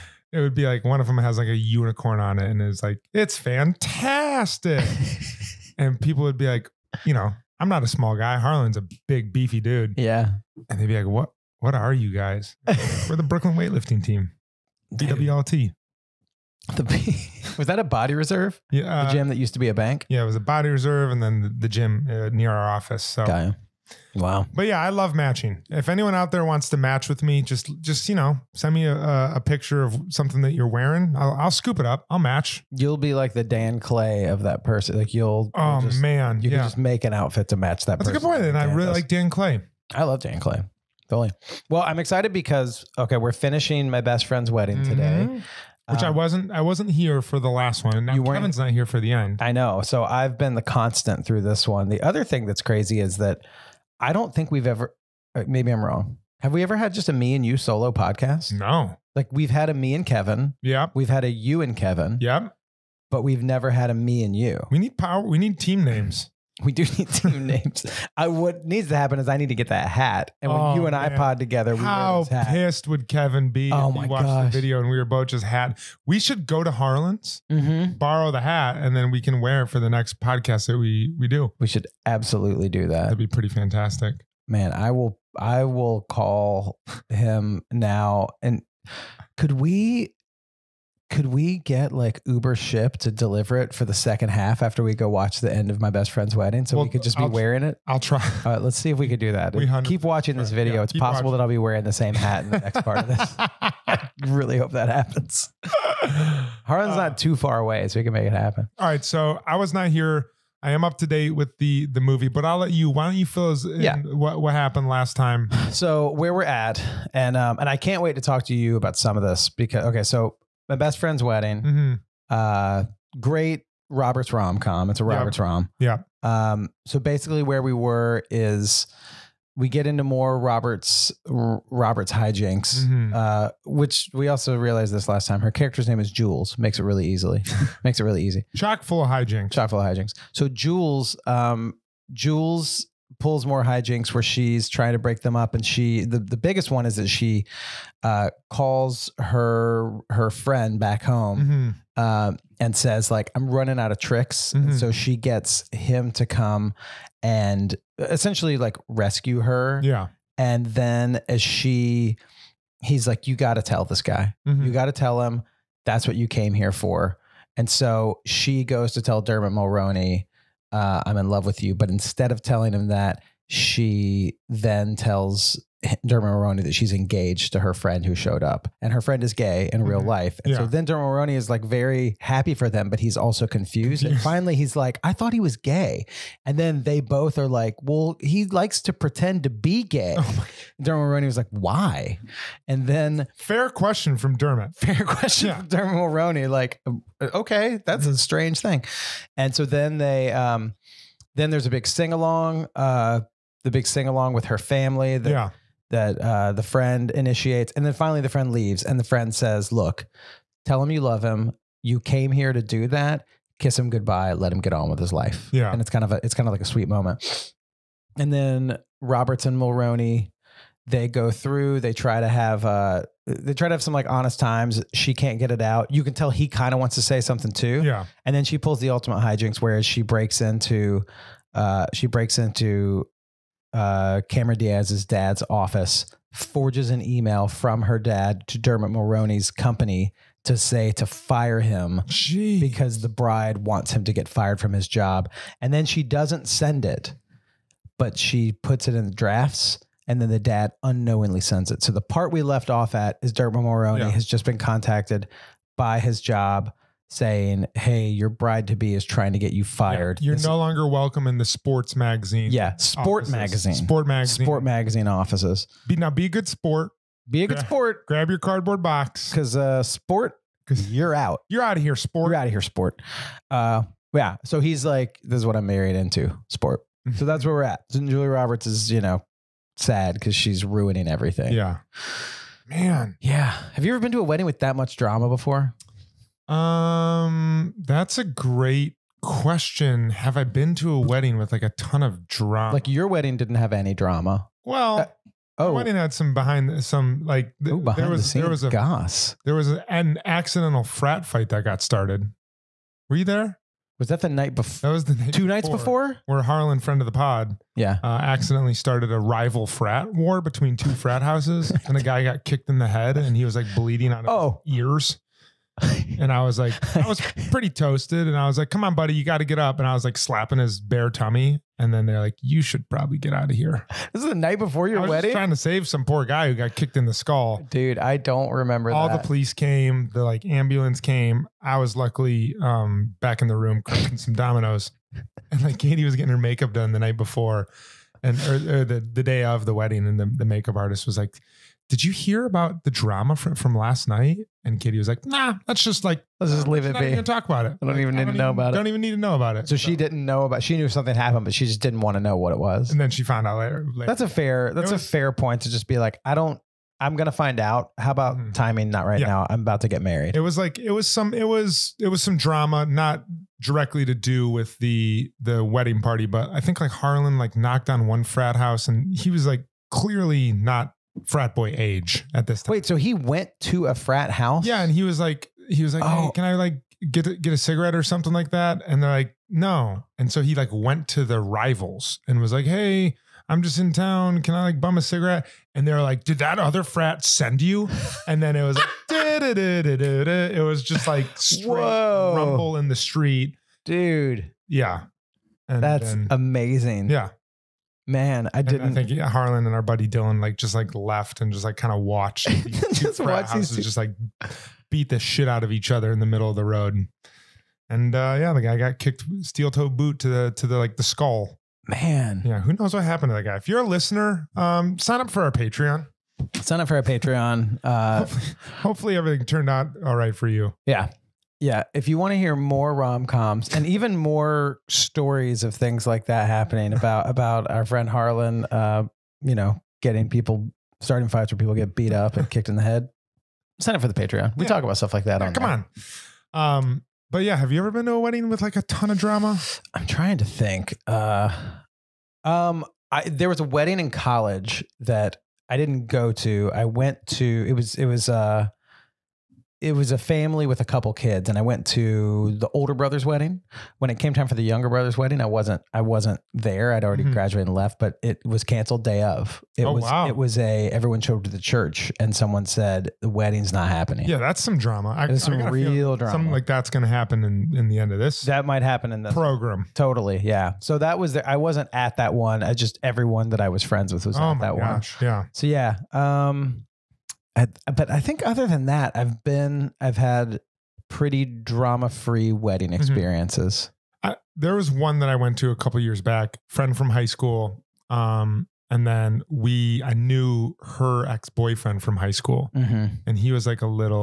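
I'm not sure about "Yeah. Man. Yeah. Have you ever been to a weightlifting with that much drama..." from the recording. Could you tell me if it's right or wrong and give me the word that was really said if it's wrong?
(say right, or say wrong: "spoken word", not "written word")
wrong: "wedding", not "weightlifting".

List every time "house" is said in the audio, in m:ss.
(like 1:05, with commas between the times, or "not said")
5:11, 6:08, 6:14.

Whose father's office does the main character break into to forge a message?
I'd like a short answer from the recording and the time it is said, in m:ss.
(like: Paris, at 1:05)
Cameron Diaz's, at 3:54.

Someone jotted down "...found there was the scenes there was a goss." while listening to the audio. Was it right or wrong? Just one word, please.
wrong.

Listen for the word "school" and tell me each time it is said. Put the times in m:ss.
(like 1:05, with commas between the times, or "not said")
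8:07, 8:12.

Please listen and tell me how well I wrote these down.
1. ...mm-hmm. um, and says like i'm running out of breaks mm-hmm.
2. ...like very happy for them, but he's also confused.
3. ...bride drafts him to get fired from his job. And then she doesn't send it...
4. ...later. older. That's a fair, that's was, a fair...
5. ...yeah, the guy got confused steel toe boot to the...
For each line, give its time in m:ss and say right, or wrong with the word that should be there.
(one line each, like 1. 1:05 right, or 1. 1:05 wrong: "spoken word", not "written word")
1. 2:31 wrong: "tricks", not "breaks"
2. 3:01 right
3. 4:03 wrong: "wants", not "drafts"
4. 5:53 wrong: "later", not "older"
5. 6:48 wrong: "kicked", not "confused".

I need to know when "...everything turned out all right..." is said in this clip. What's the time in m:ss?
6:59.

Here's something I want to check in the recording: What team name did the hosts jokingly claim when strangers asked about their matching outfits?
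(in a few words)
Brooklyn weightlifting team.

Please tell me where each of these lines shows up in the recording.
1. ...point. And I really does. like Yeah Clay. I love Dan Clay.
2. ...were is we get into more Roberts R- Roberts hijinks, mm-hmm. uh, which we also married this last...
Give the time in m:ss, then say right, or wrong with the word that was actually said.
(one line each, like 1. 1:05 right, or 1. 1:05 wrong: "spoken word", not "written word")
1. 0:38 wrong: "Dan", not "Yeah"
2. 2:07 wrong: "realized", not "married".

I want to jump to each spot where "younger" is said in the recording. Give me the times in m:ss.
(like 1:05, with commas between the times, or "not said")
7:34.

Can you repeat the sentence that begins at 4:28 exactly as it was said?
Grab your cardboard box because uh, sport.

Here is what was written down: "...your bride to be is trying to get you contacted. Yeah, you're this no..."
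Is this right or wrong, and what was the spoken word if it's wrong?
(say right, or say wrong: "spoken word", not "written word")
wrong: "fired", not "contacted".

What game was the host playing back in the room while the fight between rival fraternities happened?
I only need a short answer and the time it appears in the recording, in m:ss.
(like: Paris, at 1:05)
Dominoes, at 5:34.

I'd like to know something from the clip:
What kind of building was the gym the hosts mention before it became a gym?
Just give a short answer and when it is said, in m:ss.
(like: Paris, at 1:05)
A bank, at 0:19.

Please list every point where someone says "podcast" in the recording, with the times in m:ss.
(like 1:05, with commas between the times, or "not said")
0:57, 1:20.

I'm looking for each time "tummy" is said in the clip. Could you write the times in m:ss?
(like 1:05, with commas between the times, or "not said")
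5:21.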